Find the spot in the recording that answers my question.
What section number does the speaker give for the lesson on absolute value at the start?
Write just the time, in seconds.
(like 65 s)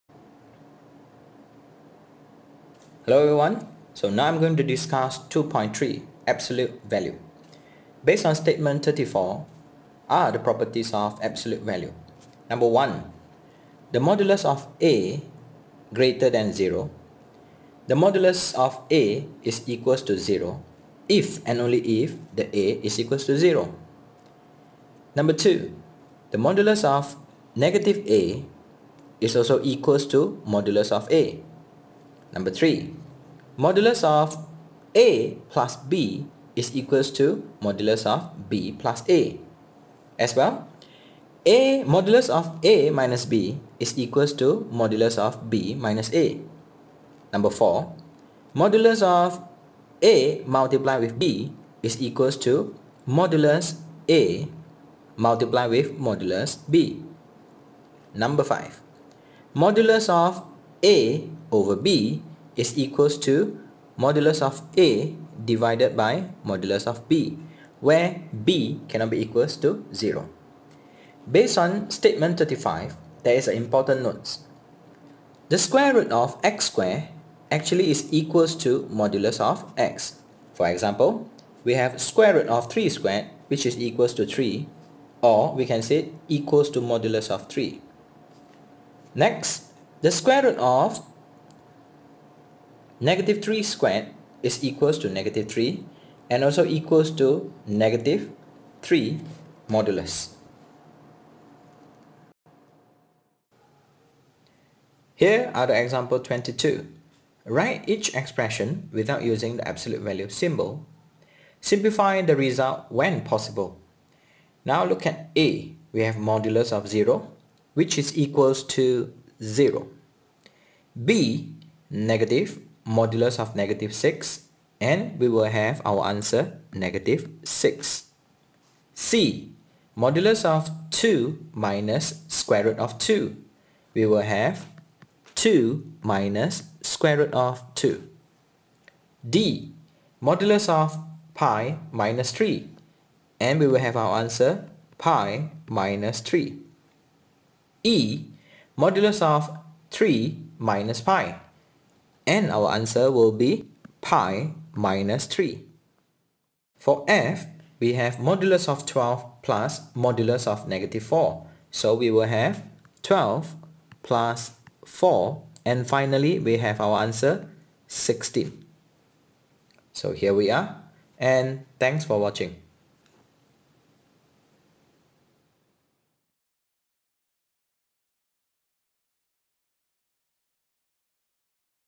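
5 s.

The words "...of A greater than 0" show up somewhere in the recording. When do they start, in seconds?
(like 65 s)
14 s.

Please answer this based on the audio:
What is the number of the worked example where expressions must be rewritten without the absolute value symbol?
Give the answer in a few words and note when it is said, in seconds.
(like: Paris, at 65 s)
22, at 106 s.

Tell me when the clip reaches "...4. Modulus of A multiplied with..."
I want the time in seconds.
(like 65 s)
47 s.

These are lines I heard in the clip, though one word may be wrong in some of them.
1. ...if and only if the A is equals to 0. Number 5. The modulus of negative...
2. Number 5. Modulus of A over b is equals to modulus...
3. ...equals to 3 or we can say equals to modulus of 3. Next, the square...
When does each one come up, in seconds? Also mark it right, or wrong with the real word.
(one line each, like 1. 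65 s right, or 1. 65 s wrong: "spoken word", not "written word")
1. 21 s wrong: "2", not "5"
2. 58 s right
3. 83 s right.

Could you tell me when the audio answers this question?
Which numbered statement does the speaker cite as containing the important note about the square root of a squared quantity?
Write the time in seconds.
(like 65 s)
72 s.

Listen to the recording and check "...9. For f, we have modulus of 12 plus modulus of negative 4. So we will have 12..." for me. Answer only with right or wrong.
wrong.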